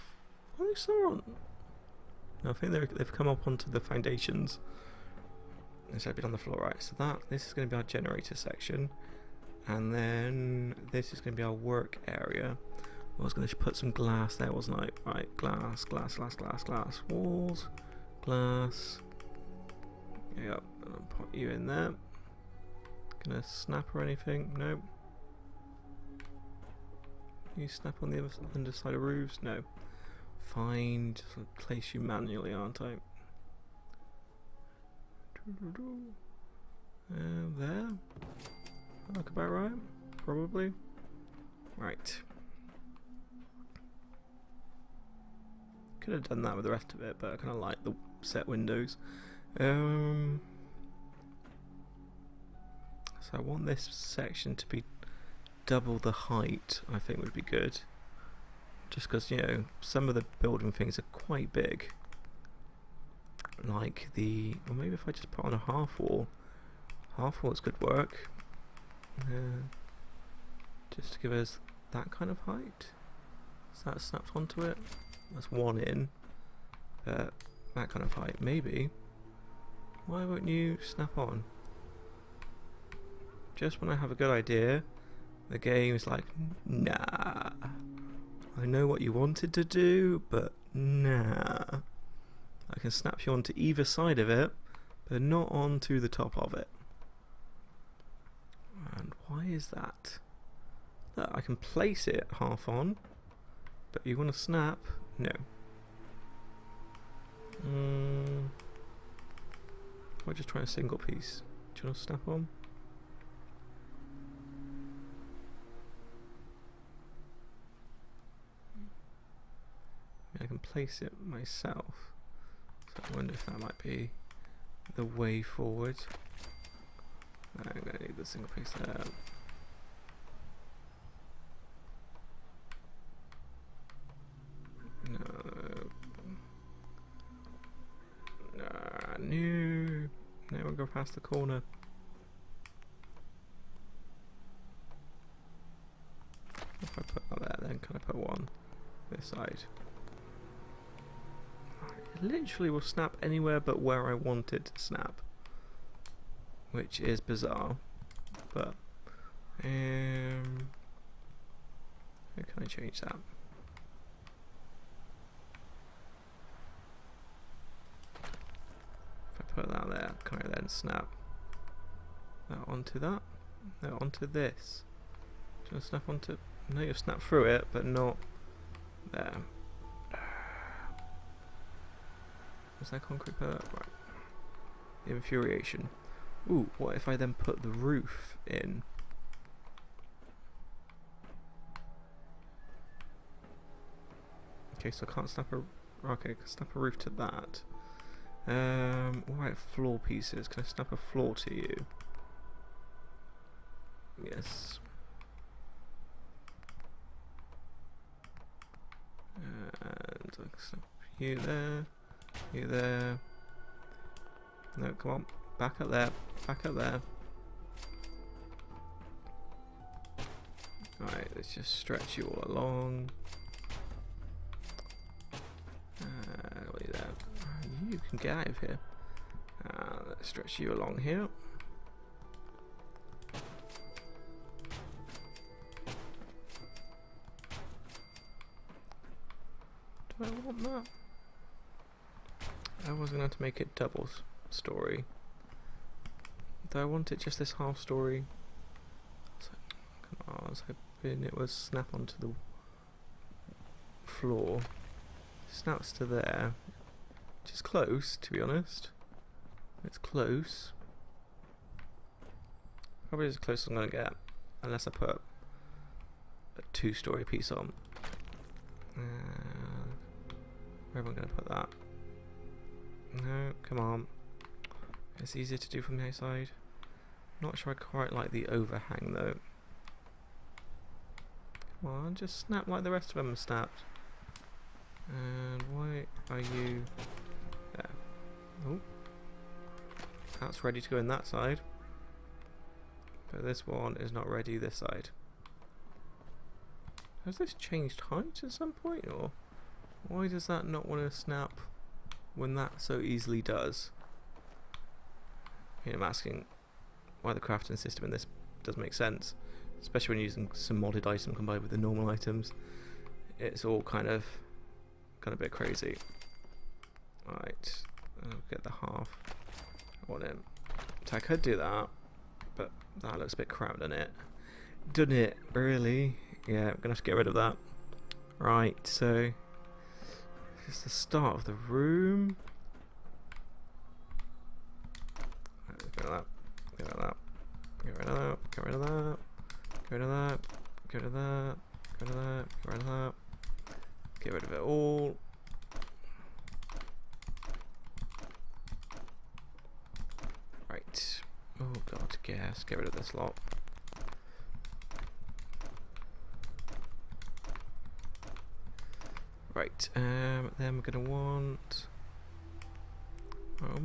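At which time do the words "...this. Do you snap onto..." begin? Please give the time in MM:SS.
02:54.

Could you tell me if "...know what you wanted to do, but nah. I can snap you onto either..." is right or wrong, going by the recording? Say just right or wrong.
right.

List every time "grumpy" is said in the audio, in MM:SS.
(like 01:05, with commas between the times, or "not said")
not said.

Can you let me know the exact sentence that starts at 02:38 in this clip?
But, um, how can I change that?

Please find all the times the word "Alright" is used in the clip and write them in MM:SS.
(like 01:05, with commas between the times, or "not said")
03:40, 05:17.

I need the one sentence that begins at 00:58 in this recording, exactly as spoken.
Just because, you know, some of the building things are quite big.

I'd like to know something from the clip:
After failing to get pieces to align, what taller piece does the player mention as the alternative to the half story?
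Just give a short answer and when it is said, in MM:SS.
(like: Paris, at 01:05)
two-story piece, at 04:26.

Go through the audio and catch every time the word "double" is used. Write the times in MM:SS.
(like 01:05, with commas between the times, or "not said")
00:55, 04:03.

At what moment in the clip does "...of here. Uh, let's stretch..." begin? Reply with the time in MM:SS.
03:48.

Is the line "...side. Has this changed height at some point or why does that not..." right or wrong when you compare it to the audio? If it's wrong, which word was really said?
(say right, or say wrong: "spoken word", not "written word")
right.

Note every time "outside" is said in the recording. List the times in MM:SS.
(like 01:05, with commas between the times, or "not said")
04:36.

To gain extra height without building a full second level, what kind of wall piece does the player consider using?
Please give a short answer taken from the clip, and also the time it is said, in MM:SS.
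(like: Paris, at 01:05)
half walls, at 01:07.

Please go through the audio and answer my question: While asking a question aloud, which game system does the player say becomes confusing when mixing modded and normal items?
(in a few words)
crafting system.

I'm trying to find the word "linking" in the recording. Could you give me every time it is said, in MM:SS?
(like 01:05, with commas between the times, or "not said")
not said.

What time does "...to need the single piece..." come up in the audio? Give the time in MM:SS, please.
02:07.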